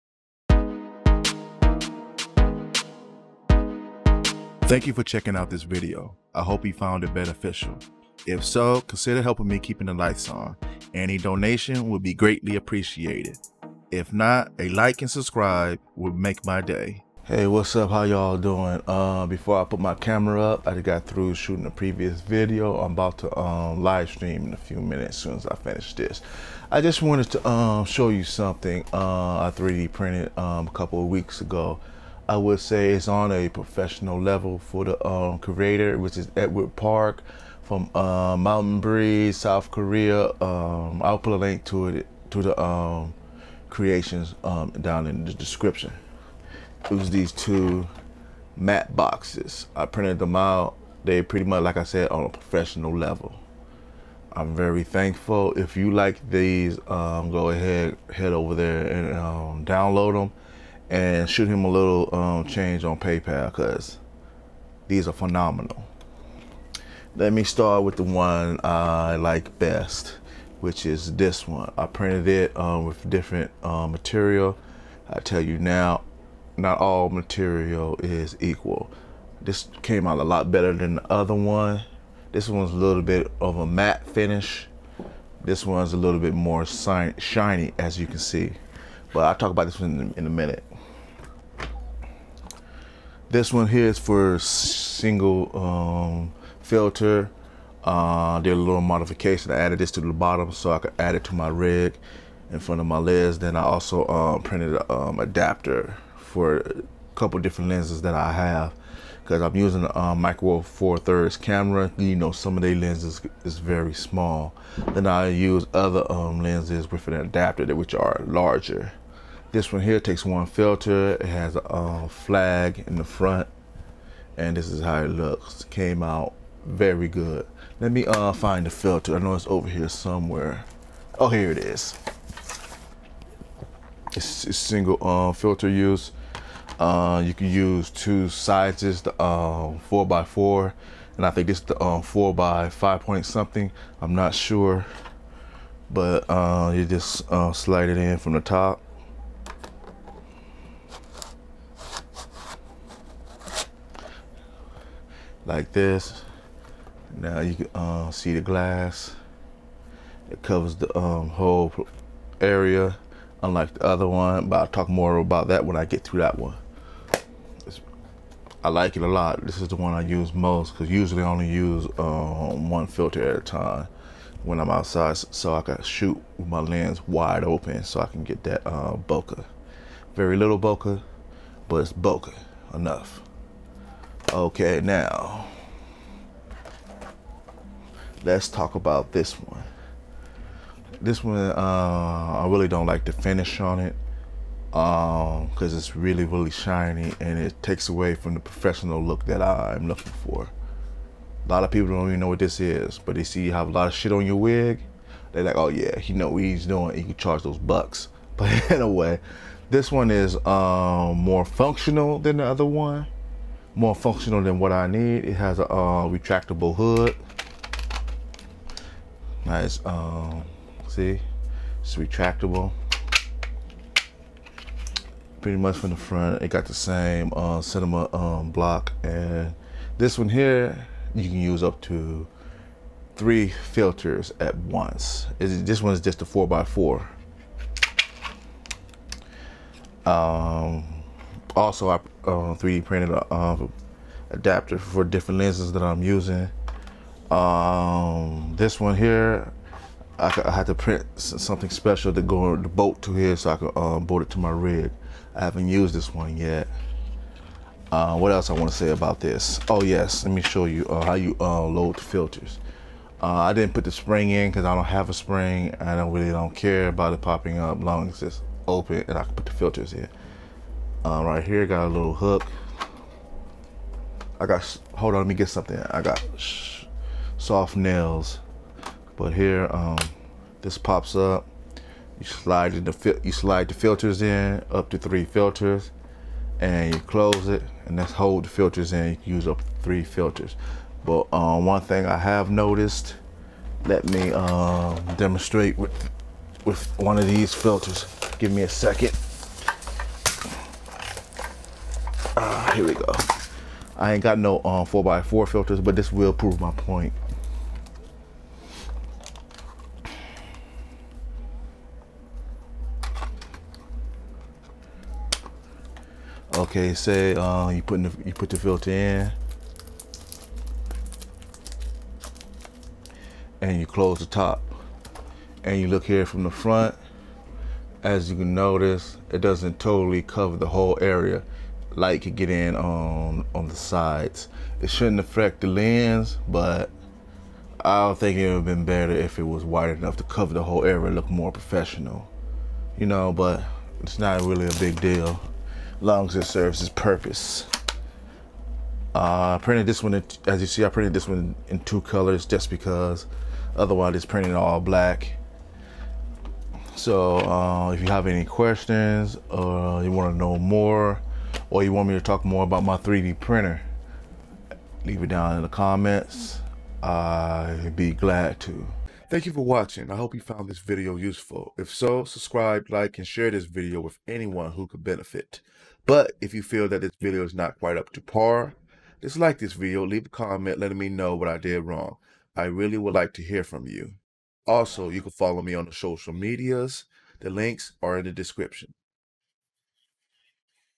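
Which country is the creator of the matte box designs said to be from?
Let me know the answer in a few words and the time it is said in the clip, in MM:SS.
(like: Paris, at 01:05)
South Korea, at 00:39.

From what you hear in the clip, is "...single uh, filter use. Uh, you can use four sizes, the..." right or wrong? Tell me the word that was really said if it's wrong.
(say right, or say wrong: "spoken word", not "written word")
wrong: "two", not "four".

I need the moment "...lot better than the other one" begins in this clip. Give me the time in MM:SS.
01:20.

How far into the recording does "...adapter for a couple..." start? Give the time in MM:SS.
01:45.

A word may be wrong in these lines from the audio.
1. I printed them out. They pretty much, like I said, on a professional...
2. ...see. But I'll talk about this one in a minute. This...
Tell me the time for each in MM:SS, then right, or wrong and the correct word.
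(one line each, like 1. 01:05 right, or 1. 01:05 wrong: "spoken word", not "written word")
1. 00:49 right
2. 01:28 right.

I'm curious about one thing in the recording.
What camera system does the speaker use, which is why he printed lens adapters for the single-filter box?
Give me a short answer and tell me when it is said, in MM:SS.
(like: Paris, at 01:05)
Micro Four Thirds, at 01:50.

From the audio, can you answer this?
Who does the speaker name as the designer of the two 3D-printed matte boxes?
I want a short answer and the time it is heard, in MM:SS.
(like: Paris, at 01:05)
Edward Park, at 00:36.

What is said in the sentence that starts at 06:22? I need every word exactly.
I really would like to hear from you.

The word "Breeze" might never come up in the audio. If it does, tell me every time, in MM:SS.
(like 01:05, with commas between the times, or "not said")
00:38.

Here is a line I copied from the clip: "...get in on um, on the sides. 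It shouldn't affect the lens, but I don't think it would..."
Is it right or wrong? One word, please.
right.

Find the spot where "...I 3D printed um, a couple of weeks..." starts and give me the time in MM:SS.
00:29.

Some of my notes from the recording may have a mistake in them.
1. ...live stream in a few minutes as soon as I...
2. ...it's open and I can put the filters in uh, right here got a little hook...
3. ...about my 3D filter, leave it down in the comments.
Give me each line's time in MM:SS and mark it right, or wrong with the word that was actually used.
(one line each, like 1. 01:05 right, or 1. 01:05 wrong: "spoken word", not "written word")
1. 00:23 right
2. 04:28 right
3. 06:02 wrong: "printer", not "filter".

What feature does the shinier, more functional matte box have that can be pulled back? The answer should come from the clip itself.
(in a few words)
A retractable hood.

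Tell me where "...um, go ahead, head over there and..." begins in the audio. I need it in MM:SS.
00:56.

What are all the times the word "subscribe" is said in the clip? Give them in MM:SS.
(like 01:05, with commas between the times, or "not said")
00:15, 06:12.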